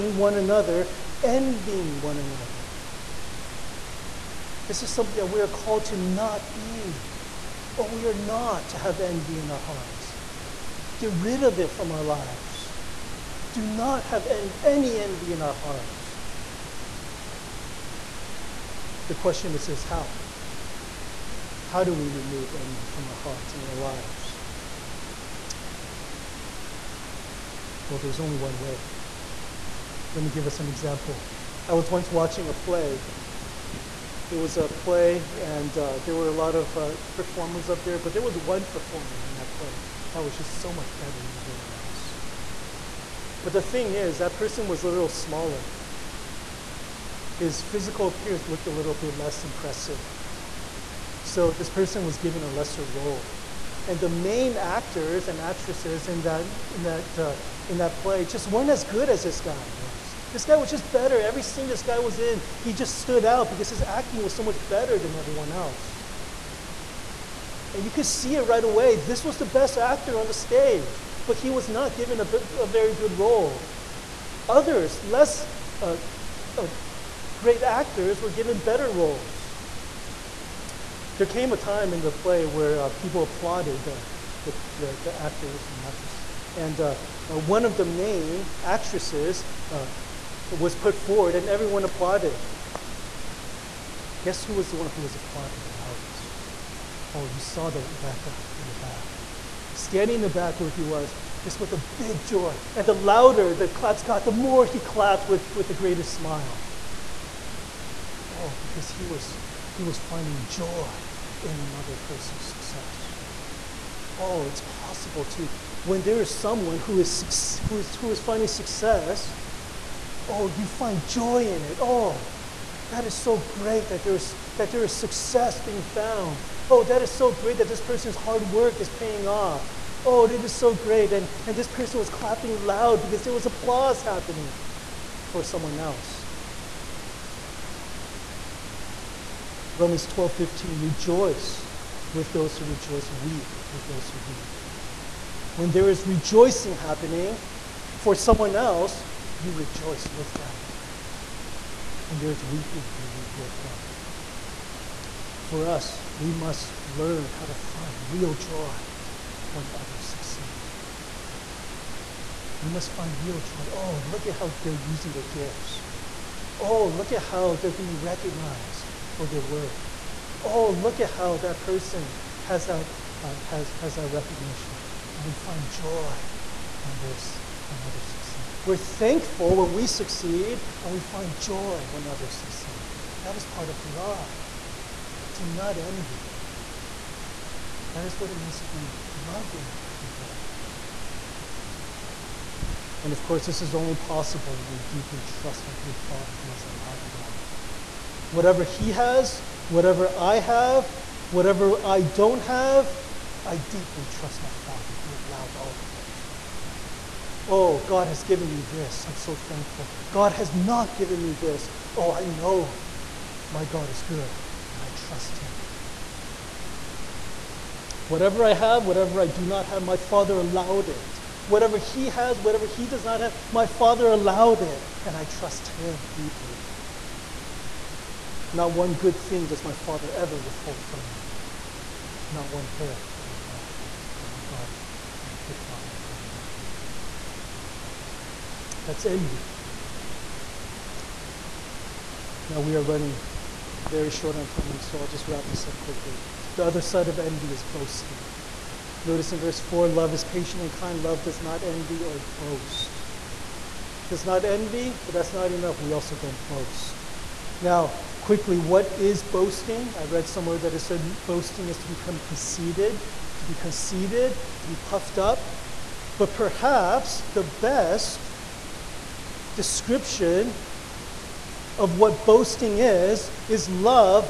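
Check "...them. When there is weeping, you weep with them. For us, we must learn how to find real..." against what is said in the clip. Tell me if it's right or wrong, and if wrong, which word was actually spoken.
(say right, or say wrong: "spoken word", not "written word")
right.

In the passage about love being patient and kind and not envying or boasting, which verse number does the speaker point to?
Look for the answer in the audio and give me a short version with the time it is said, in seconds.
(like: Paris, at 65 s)
Verse 4, at 249 s.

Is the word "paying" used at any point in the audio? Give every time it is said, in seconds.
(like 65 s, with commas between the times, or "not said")
128 s.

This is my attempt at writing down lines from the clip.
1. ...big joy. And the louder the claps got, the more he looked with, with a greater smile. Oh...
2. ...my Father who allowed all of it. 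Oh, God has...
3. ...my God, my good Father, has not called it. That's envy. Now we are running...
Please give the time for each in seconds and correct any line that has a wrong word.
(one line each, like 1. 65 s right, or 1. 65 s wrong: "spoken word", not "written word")
1. 101 s wrong: "clapped", not "looked"
2. 204 s right
3. 234 s wrong: "allowed", not "called".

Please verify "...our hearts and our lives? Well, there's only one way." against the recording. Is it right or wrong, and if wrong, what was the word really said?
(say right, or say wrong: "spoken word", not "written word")
right.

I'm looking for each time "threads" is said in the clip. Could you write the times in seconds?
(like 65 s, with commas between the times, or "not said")
not said.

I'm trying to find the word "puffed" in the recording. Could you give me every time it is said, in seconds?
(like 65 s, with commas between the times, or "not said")
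264 s.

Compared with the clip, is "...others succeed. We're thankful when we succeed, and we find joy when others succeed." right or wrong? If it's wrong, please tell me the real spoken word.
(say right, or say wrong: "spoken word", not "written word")
right.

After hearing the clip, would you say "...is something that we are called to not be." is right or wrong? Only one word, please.
right.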